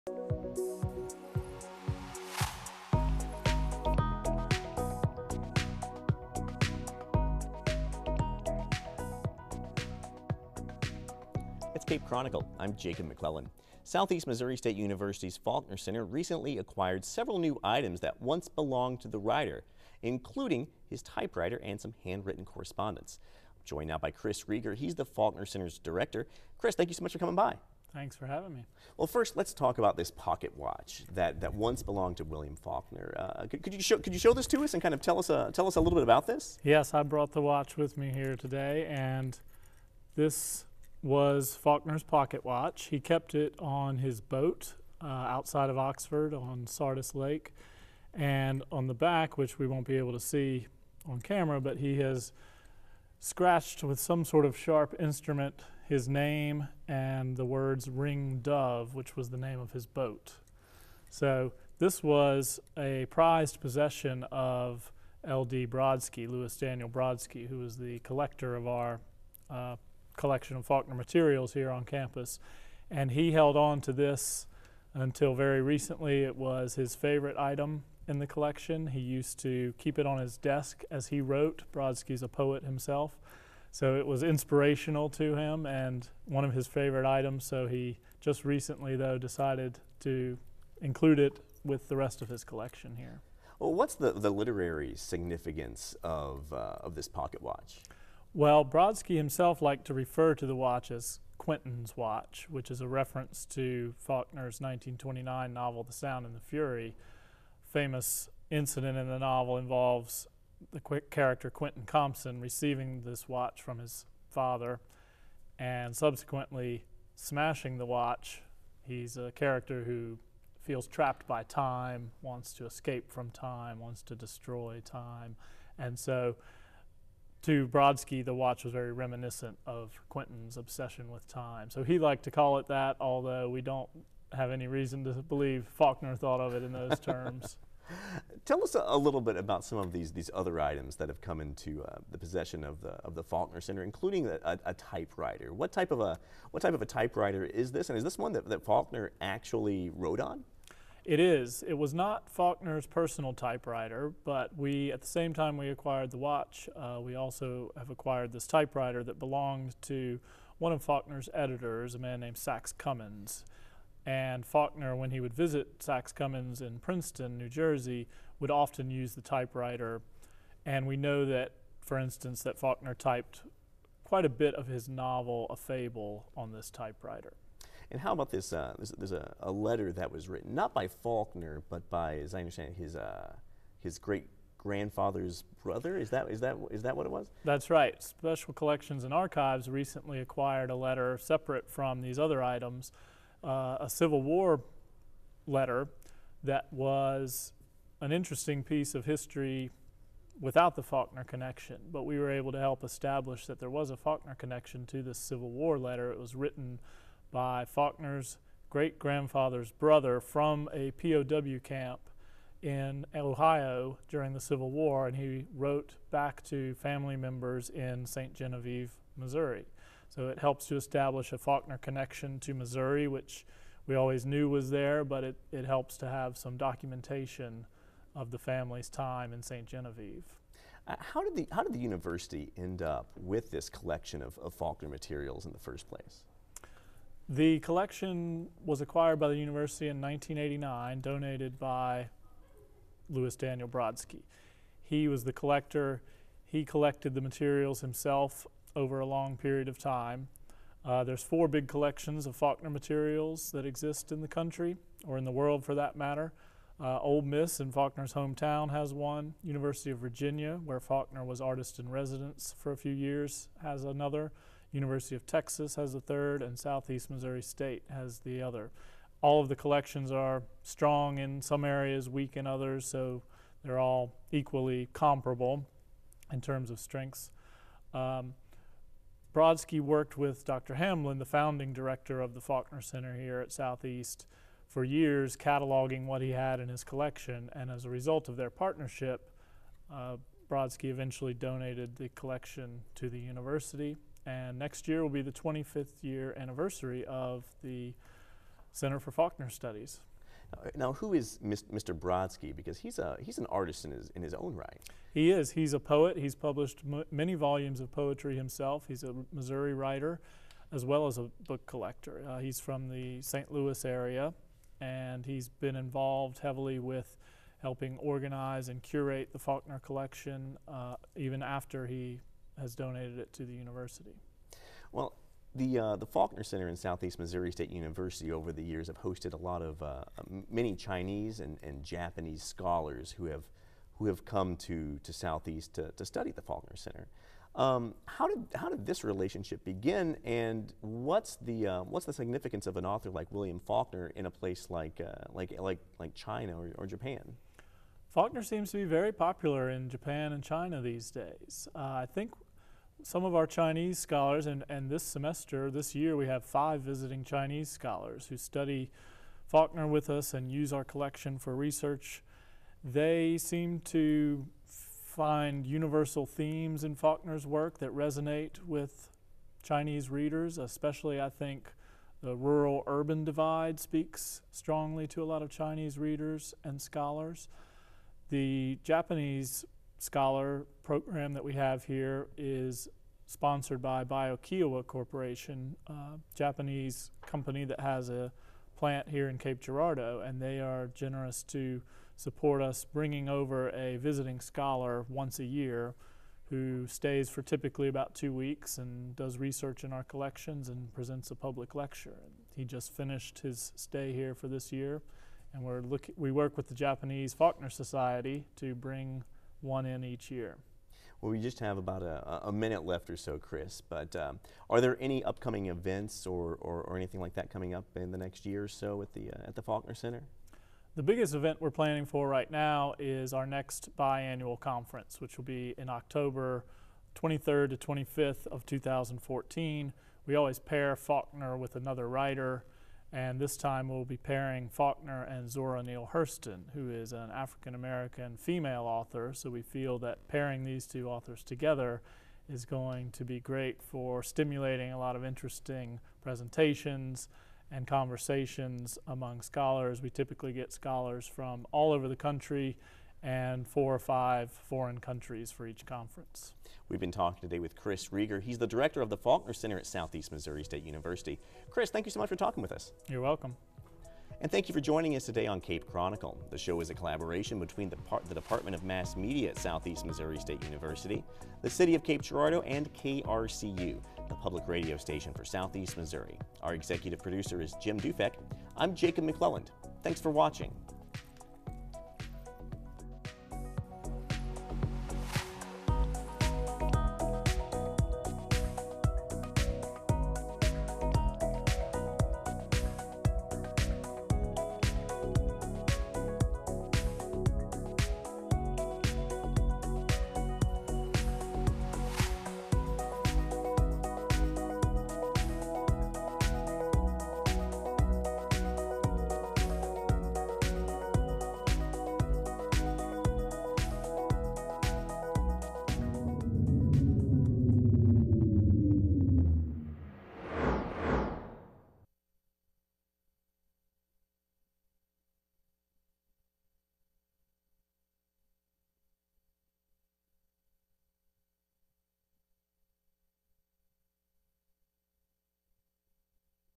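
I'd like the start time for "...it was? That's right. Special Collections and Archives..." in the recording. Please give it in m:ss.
3:07.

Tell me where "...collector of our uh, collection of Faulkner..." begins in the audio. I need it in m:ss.
1:07.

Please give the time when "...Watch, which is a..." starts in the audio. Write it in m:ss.
1:41.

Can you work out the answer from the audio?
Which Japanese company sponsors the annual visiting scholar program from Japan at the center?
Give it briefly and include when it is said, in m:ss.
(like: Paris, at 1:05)
BioKyowa Corporation, at 6:24.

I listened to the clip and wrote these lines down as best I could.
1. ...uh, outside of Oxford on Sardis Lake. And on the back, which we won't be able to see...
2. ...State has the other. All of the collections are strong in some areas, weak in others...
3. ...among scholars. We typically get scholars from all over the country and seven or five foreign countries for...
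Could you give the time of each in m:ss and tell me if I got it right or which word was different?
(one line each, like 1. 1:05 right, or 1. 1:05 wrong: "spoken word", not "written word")
1. 0:45 right
2. 4:27 right
3. 7:29 wrong: "four", not "seven".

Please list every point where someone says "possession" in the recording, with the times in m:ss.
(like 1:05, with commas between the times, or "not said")
1:03, 2:22.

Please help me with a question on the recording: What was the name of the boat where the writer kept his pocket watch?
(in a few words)
Ring Dove.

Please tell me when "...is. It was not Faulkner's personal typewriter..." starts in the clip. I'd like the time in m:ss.
2:31.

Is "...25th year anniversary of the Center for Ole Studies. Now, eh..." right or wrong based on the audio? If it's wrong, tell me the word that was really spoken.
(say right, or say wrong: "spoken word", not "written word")
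wrong: "Faulkner", not "Ole".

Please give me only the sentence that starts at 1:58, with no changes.
He's a character who feels trapped by time, wants to escape from time, wants to destroy time.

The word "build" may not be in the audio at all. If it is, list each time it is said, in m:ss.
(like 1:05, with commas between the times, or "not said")
not said.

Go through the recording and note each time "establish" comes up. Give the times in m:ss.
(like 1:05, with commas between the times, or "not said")
3:22, 3:40.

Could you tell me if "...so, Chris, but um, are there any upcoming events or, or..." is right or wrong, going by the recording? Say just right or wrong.
right.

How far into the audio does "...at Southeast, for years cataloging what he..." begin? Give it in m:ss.
4:43.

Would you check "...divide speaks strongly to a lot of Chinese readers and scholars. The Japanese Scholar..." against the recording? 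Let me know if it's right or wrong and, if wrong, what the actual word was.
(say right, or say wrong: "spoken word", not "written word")
right.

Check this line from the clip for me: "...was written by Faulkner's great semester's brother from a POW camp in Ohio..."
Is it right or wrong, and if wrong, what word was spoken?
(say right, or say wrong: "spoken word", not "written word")
wrong: "grandfather", not "semester".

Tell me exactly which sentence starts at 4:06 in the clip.
He collected the materials himself over a long period of time.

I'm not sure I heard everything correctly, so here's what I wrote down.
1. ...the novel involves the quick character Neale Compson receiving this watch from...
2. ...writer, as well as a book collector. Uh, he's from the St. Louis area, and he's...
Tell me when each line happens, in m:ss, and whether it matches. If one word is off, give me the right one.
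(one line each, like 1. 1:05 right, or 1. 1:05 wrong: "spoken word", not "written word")
1. 1:49 wrong: "Quentin", not "Neale"
2. 5:09 right.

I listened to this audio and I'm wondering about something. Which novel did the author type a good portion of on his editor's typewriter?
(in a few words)
A Fable.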